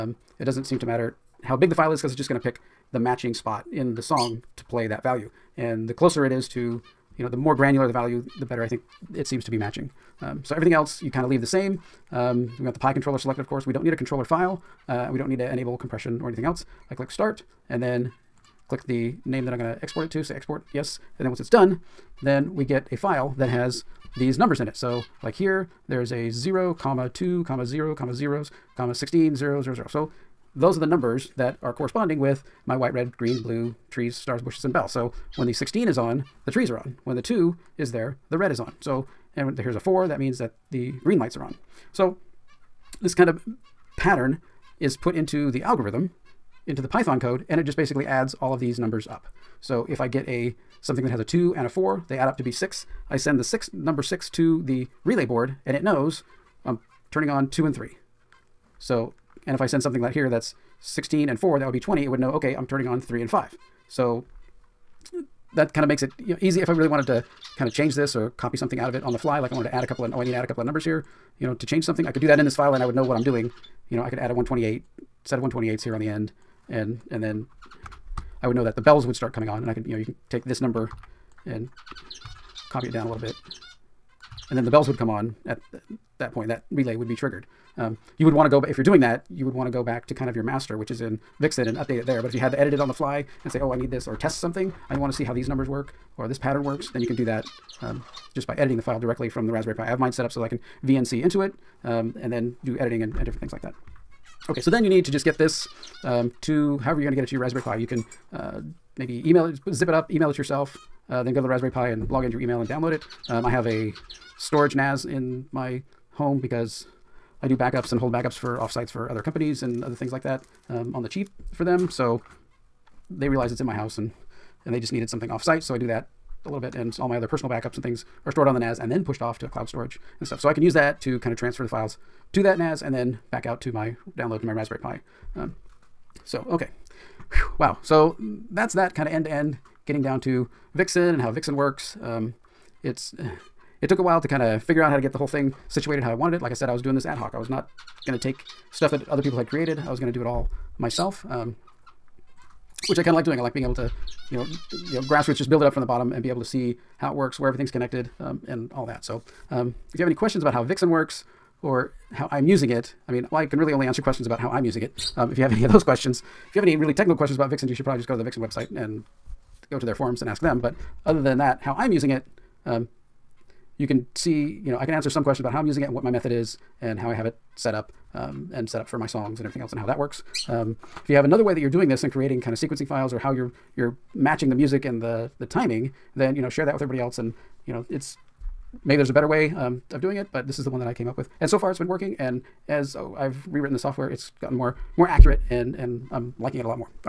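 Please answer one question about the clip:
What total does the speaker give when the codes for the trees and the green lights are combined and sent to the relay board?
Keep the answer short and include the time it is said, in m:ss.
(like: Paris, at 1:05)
20, at 1:01.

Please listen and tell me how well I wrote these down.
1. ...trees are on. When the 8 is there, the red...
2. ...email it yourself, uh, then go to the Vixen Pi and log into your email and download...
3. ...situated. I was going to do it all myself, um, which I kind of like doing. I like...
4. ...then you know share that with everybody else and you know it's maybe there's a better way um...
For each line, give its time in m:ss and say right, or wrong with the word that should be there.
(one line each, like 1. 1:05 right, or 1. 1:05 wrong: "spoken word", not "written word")
1. 0:36 wrong: "2", not "8"
2. 1:50 wrong: "Raspberry", not "Vixen"
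3. 2:29 wrong: "created", not "situated"
4. 3:06 right.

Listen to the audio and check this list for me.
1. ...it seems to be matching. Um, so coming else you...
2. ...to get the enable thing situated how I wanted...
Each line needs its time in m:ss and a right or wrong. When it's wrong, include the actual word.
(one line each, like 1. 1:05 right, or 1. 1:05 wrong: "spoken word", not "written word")
1. 0:09 wrong: "everything", not "coming"
2. 2:24 wrong: "whole", not "enable".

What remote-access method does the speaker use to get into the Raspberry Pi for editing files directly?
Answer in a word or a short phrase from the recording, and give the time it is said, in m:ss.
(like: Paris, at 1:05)
VNC, at 1:40.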